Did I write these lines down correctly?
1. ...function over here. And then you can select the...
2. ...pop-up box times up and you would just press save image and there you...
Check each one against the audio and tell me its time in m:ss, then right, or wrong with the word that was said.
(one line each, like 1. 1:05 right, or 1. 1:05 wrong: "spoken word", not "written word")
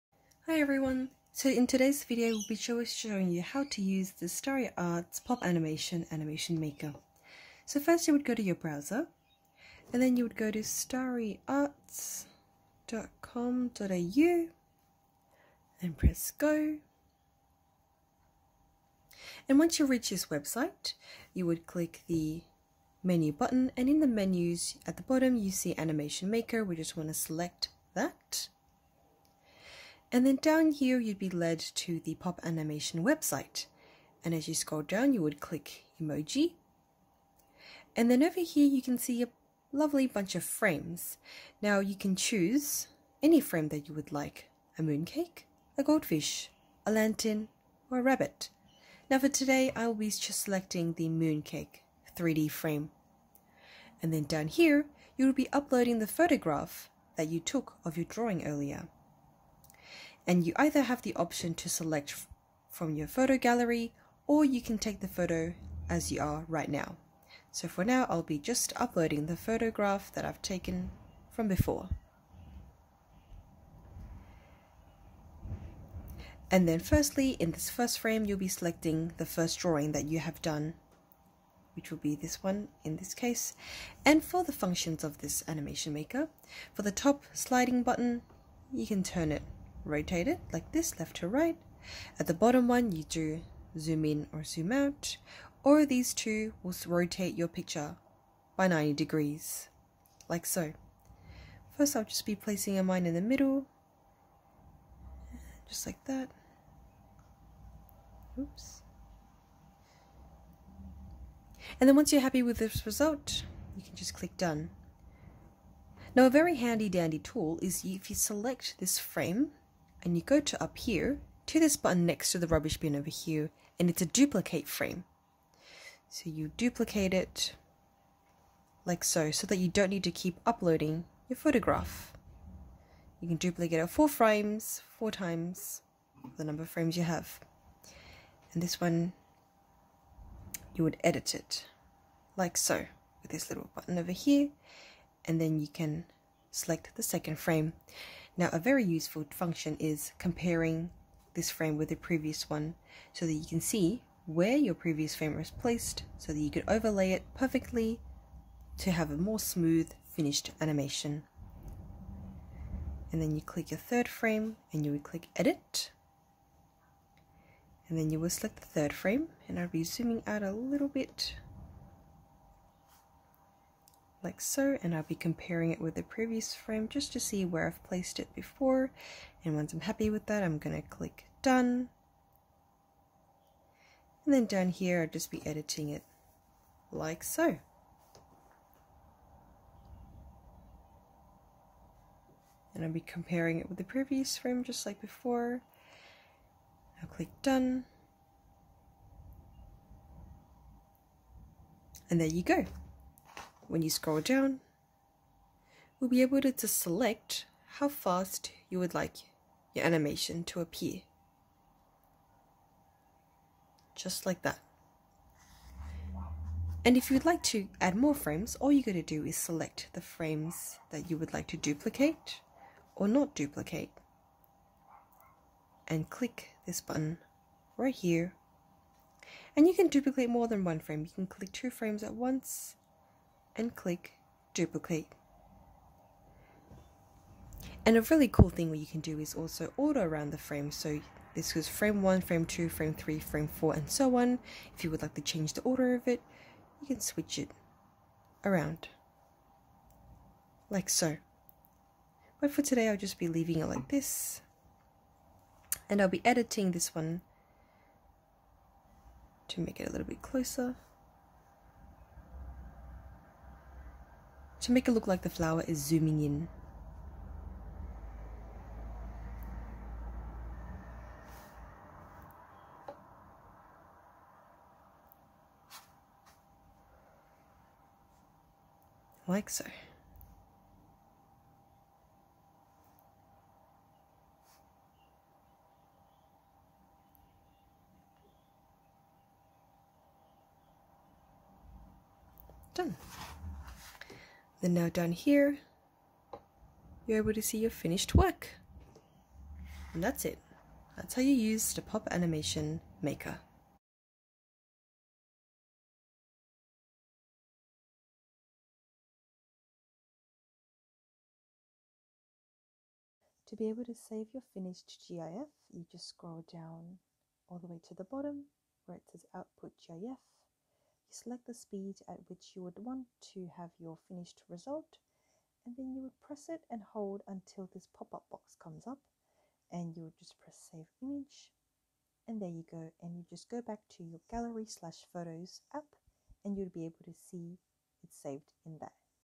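1. 2:23 wrong: "button", not "function"
2. 5:27 wrong: "comes", not "times".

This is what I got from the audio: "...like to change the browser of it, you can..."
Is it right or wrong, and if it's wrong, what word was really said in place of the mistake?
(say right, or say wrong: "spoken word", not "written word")
wrong: "order", not "browser".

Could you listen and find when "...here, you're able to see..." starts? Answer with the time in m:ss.
4:55.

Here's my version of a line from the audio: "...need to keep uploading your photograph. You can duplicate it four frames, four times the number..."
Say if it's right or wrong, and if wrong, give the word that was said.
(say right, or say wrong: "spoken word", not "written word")
right.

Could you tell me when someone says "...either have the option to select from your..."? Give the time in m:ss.
1:00.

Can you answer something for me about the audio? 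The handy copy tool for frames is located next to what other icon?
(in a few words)
rubbish bin.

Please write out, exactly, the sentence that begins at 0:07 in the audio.
So first you would go to your browser, and then you would go to starryarts.com.au and press go.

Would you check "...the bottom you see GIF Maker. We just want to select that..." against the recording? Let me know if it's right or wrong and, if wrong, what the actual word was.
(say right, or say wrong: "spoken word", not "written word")
wrong: "Animation", not "GIF".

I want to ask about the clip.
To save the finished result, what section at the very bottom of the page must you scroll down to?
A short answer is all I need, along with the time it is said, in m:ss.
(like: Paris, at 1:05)
Output GIF, at 5:19.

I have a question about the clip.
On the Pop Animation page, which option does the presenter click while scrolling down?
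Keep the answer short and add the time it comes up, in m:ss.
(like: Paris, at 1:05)
emoji, at 0:36.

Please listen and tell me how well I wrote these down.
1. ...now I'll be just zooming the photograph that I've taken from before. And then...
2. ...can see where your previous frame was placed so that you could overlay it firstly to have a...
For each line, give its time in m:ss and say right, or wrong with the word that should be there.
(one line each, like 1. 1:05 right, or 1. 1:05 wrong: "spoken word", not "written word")
1. 1:07 wrong: "uploading", not "zooming"
2. 2:33 wrong: "perfectly", not "firstly".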